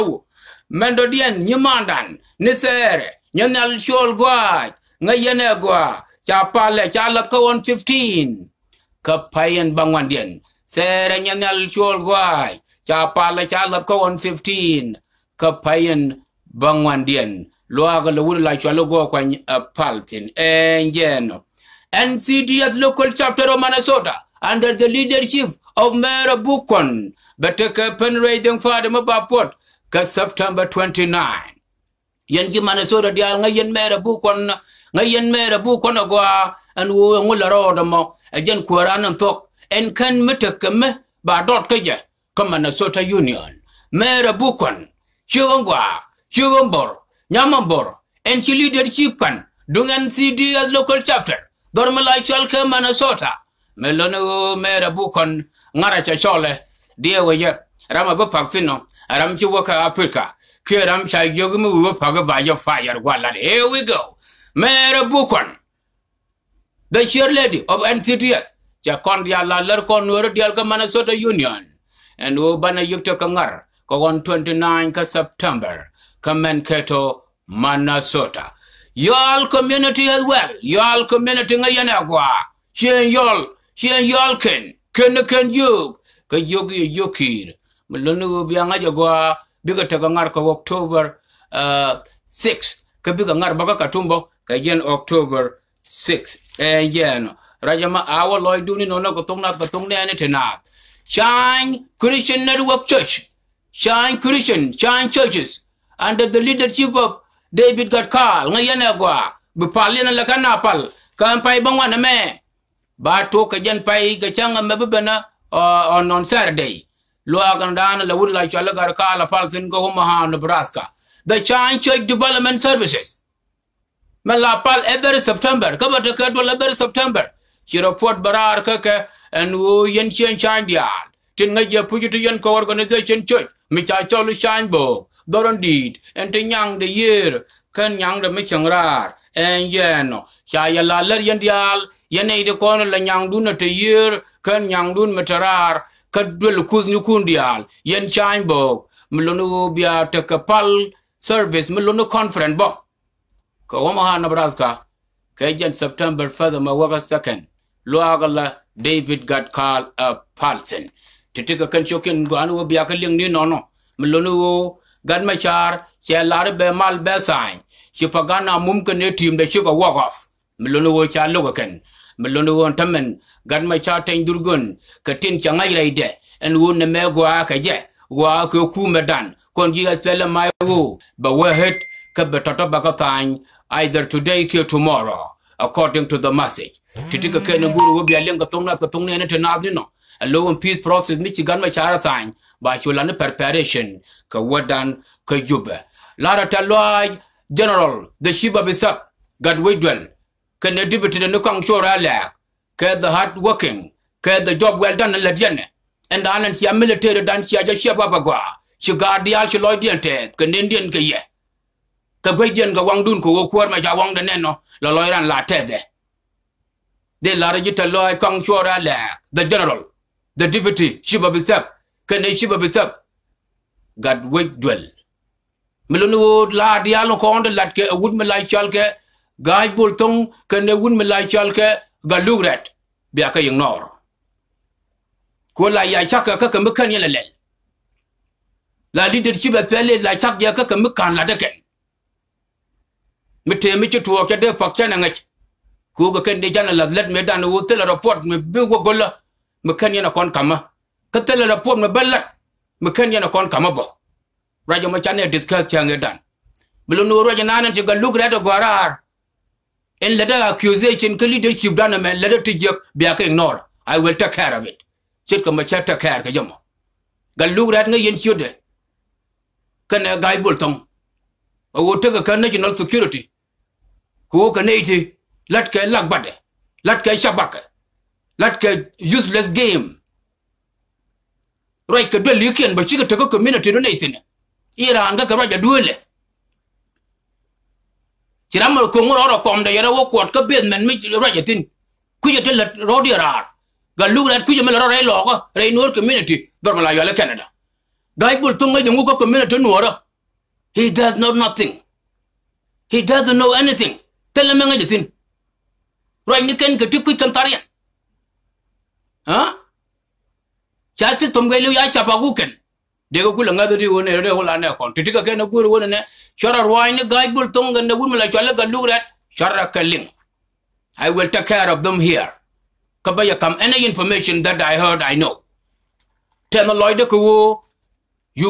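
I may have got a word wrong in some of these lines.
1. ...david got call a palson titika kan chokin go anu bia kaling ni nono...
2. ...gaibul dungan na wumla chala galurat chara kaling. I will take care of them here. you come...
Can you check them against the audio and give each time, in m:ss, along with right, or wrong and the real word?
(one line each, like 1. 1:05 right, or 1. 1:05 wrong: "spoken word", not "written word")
1. 2:38 right
2. 5:17 wrong: "tongan", not "dungan".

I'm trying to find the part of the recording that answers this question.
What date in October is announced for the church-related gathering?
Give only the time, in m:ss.
1:34.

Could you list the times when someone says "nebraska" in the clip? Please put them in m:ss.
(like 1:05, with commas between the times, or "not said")
2:00, 2:34.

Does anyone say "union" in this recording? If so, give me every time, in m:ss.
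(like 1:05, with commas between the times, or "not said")
0:43, 1:11.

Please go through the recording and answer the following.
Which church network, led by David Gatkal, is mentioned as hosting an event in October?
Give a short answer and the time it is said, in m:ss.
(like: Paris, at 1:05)
Shine Christian Network Church, at 1:41.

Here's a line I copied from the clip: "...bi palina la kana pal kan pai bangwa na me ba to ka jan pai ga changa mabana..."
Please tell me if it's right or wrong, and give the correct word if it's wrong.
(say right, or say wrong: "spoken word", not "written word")
right.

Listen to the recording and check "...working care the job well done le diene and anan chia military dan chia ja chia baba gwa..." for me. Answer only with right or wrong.
right.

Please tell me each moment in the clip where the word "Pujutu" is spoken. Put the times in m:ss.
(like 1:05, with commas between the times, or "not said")
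2:11.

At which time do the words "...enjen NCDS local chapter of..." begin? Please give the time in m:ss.
0:20.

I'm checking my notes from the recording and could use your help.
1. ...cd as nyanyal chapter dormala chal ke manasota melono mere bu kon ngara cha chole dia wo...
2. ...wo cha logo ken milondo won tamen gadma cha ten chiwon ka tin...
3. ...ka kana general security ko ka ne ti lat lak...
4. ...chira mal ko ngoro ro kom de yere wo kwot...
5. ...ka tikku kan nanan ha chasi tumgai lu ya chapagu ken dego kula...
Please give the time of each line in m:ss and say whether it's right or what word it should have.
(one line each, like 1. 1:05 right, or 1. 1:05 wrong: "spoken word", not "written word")
1. 0:50 wrong: "local", not "nyanyal"
2. 2:50 wrong: "durgon", not "chiwon"
3. 4:32 wrong: "national", not "general"
4. 4:48 right
5. 5:06 wrong: "tarian", not "nanan".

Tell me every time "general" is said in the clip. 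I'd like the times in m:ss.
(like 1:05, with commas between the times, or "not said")
3:17, 3:39.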